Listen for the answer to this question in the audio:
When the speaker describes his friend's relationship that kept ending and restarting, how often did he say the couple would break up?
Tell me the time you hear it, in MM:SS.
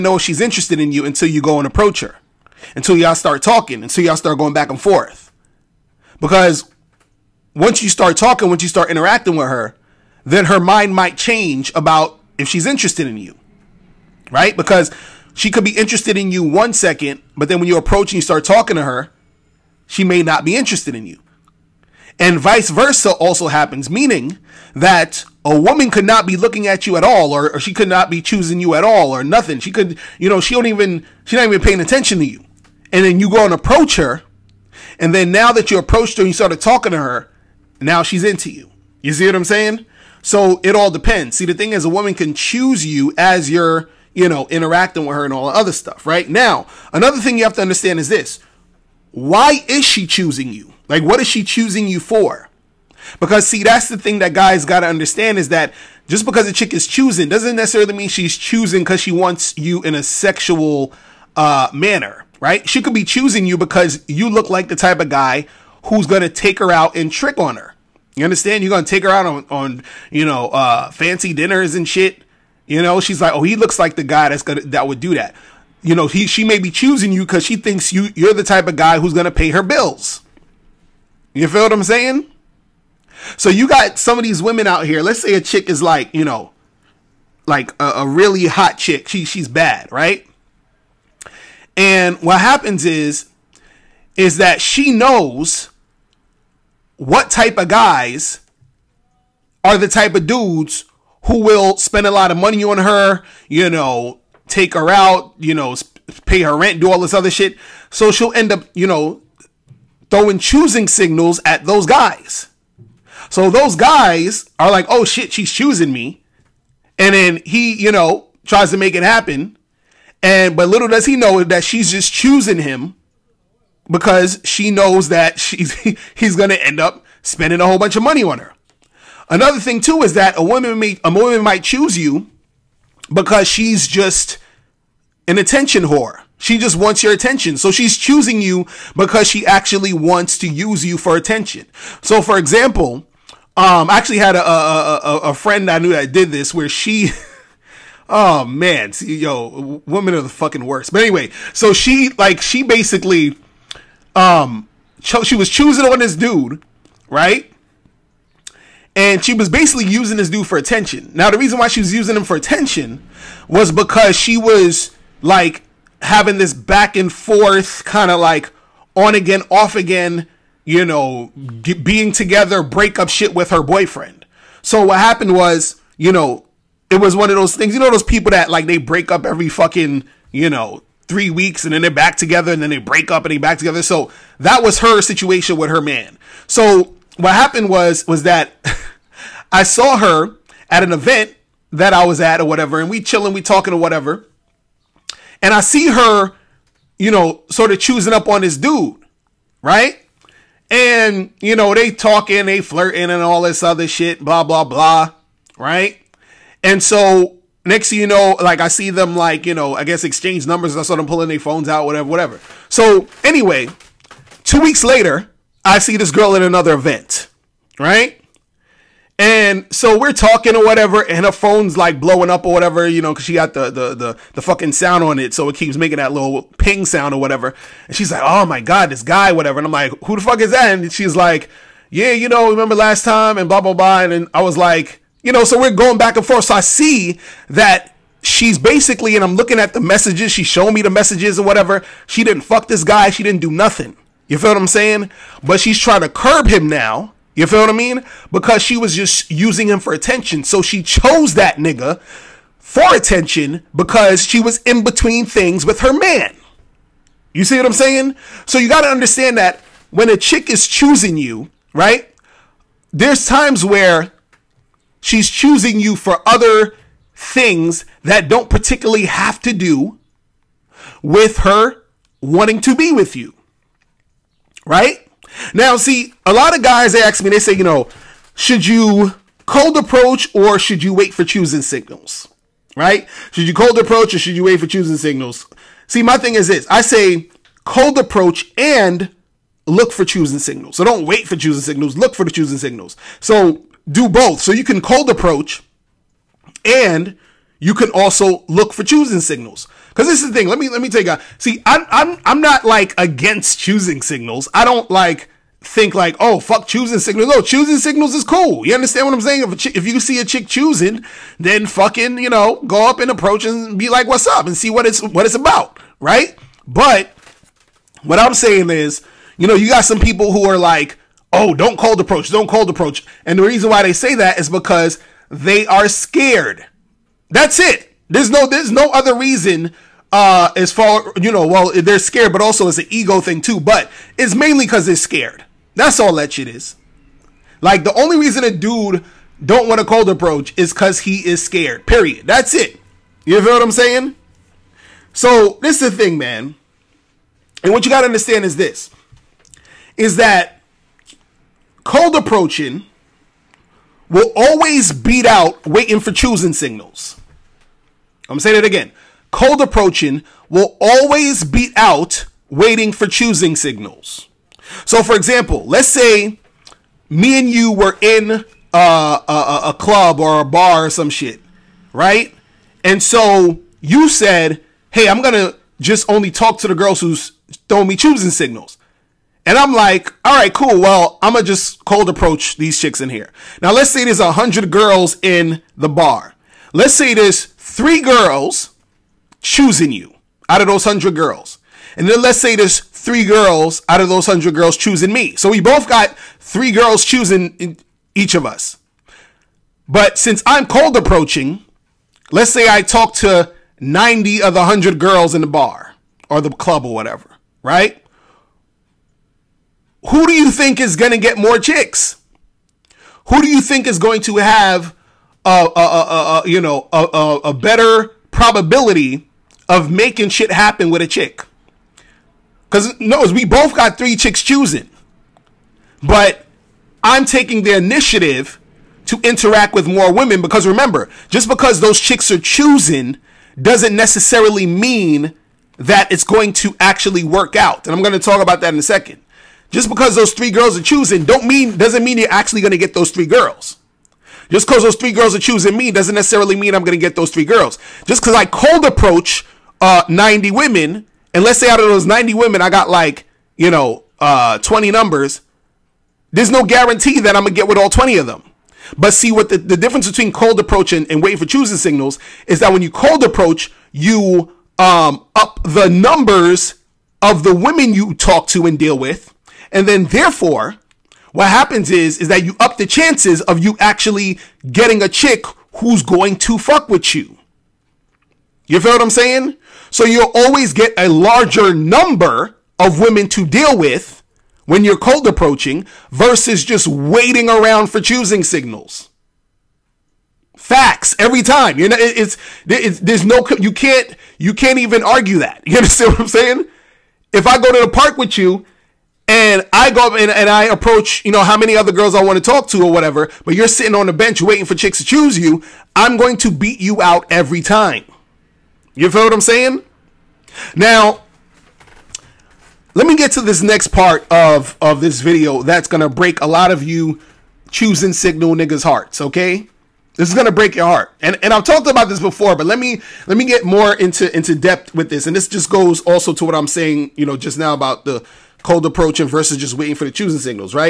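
03:01.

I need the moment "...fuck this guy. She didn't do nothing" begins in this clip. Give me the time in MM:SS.
04:02.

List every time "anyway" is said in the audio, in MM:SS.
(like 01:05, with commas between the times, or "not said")
02:31, 03:33.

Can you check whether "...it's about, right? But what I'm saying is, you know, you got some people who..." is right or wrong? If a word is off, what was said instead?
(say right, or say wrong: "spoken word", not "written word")
right.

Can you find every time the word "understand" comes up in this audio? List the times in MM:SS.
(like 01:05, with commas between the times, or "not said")
00:47, 00:54, 01:08, 04:18, 05:08, 05:48, 08:15.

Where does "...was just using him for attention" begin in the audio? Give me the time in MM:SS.
04:08.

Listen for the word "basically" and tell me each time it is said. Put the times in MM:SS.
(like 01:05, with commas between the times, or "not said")
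02:32, 02:39, 03:58.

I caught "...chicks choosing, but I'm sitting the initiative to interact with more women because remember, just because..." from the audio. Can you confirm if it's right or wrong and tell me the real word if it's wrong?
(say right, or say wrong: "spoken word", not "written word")
wrong: "taking", not "sitting".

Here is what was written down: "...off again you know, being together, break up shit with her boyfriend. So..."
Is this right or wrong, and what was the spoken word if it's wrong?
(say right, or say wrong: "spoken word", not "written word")
right.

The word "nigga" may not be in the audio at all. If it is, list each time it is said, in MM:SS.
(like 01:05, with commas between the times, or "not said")
04:11, 08:38.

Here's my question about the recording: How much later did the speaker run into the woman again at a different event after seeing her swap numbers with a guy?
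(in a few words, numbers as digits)
2 weeks.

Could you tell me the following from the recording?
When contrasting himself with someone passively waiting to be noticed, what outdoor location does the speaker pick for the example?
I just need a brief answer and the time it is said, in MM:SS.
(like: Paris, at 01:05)
the park, at 08:17.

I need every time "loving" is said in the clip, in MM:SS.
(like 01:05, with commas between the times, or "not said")
not said.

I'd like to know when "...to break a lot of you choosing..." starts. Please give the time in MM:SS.
08:35.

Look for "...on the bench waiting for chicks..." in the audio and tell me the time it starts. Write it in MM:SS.
08:23.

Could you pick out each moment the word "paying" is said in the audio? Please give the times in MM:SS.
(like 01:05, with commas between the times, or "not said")
00:31.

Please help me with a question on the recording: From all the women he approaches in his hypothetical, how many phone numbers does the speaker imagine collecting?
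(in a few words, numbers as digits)
20.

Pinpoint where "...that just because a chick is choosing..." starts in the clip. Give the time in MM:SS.
00:55.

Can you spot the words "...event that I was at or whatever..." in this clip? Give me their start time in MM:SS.
03:10.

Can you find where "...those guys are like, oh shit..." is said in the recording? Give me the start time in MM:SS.
01:53.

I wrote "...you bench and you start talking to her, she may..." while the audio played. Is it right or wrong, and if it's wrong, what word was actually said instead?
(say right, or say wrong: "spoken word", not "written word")
wrong: "approach", not "bench".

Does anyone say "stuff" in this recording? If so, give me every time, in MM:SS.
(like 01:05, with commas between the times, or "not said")
00:45.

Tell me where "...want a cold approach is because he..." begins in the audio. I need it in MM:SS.
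05:39.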